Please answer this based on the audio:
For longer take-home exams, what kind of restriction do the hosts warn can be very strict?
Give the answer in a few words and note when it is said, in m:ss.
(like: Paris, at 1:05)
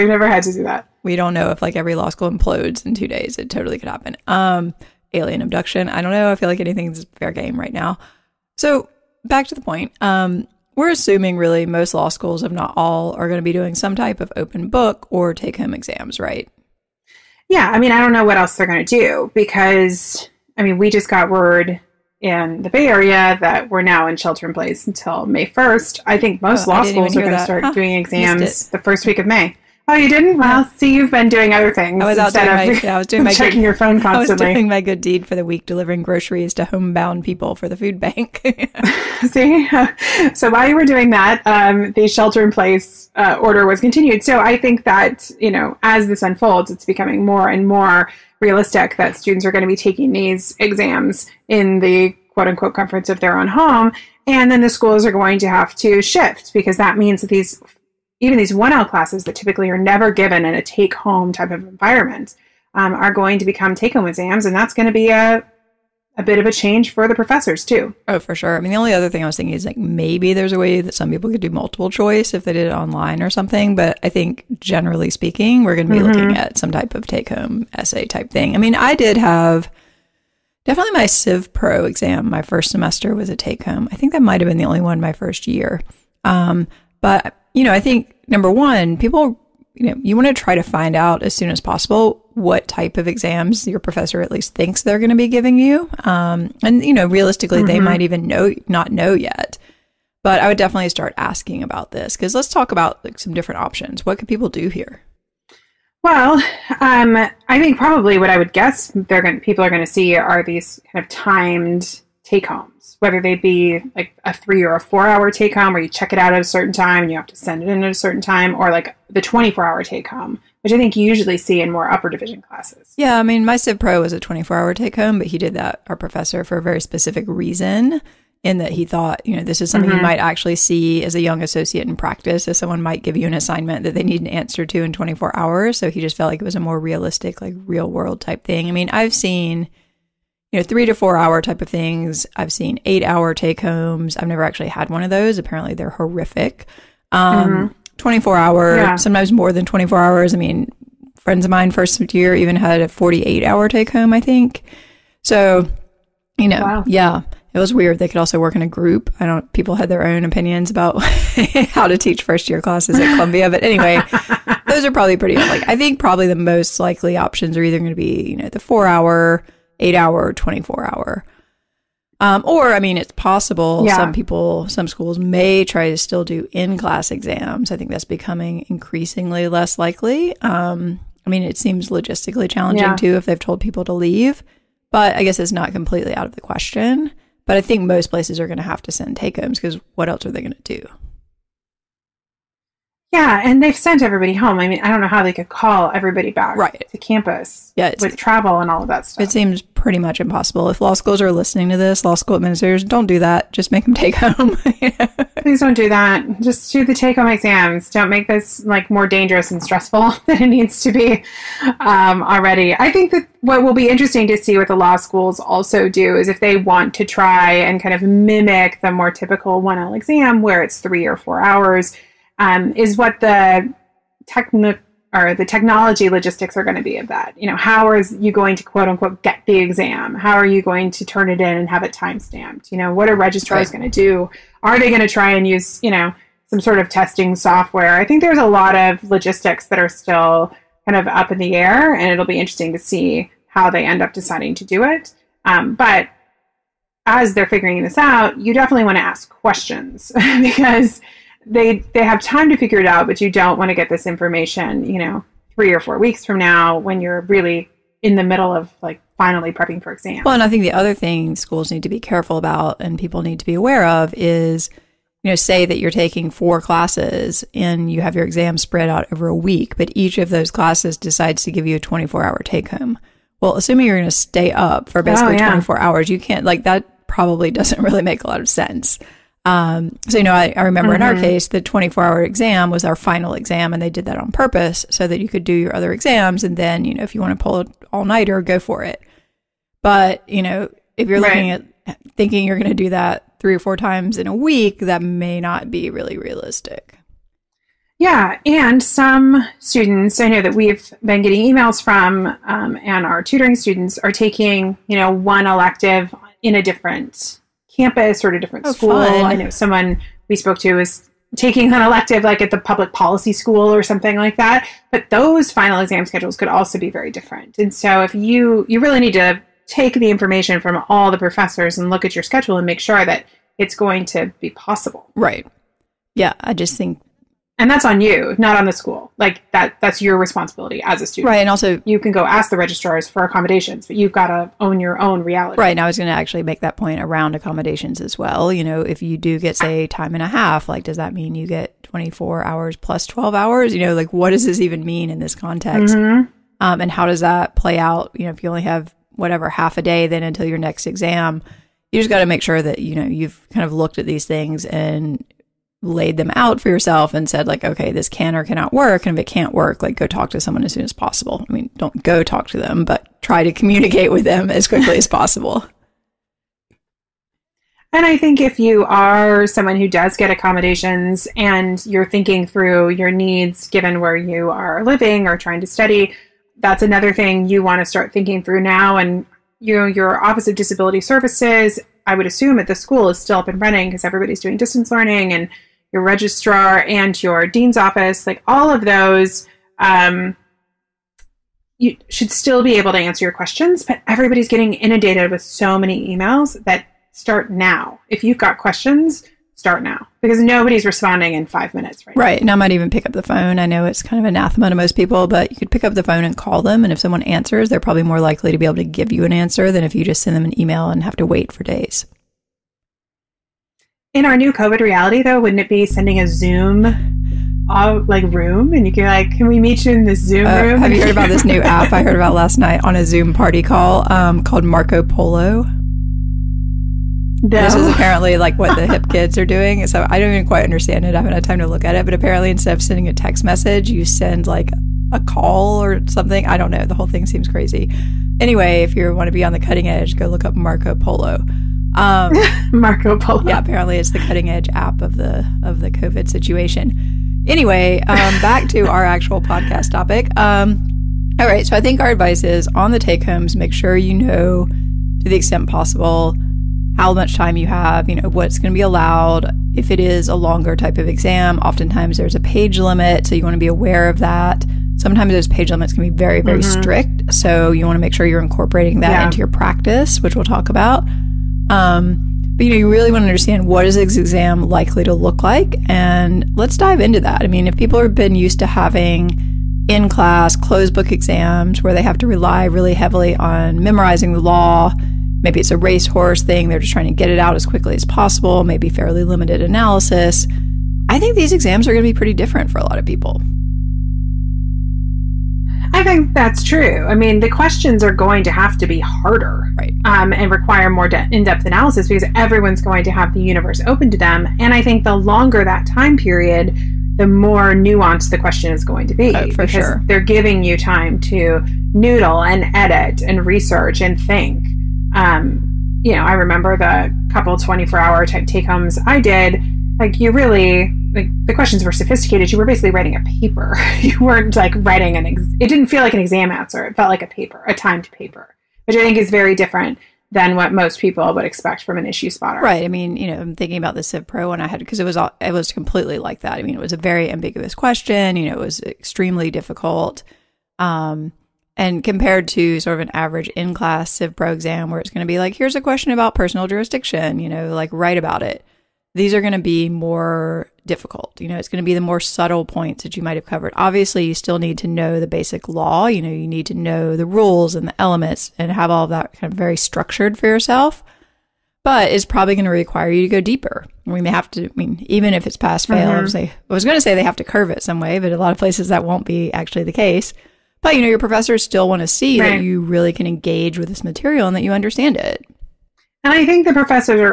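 page limit, at 7:42.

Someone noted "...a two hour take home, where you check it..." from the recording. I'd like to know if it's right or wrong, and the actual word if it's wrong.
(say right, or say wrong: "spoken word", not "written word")
wrong: "four", not "two".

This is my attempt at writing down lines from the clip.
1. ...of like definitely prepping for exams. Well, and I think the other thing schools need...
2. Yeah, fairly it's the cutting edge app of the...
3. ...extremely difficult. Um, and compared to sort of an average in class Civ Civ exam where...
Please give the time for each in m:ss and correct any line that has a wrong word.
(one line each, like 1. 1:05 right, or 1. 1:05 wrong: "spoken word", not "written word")
1. 4:18 wrong: "finally", not "definitely"
2. 7:23 wrong: "apparently", not "fairly"
3. 8:58 wrong: "Pro", not "Civ".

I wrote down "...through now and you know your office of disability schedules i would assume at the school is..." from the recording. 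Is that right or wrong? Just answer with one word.
wrong.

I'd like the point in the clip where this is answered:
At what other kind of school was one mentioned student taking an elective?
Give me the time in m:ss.
5:12.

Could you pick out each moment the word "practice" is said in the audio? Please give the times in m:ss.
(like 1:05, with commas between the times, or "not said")
2:11, 7:49.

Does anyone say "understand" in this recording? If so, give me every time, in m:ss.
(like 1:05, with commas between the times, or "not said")
7:10, 7:53, 9:34.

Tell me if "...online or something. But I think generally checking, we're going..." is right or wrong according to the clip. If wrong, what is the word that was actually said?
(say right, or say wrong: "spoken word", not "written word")
wrong: "speaking", not "checking".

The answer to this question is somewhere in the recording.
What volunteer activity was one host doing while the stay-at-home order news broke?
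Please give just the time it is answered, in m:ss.
0:35.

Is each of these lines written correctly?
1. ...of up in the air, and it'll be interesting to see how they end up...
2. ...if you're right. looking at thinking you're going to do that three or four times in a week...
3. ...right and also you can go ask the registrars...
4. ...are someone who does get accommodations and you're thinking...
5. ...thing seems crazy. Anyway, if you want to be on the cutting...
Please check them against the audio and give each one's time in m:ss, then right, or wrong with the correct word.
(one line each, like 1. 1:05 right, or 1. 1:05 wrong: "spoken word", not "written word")
1. 4:00 right
2. 4:50 right
3. 5:31 right
4. 6:08 right
5. 7:17 right.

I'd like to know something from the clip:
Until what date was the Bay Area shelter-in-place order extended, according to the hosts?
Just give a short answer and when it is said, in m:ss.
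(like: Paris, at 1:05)
May 1st, at 0:25.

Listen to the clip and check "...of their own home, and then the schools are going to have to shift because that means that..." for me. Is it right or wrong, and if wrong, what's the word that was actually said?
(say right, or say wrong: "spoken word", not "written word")
right.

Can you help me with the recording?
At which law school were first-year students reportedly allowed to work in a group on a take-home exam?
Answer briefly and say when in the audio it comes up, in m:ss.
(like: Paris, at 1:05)
Columbia, at 2:43.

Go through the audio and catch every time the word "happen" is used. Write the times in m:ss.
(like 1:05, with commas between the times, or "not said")
0:03.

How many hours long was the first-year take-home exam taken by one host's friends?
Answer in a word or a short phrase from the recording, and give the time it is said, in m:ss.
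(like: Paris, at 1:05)
48, at 2:32.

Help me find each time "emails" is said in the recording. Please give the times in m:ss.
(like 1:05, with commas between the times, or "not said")
5:01, 6:36, 6:50.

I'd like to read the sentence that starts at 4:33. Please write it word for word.
Well, assuming you're going to stay up for oh, basically oh, yeah.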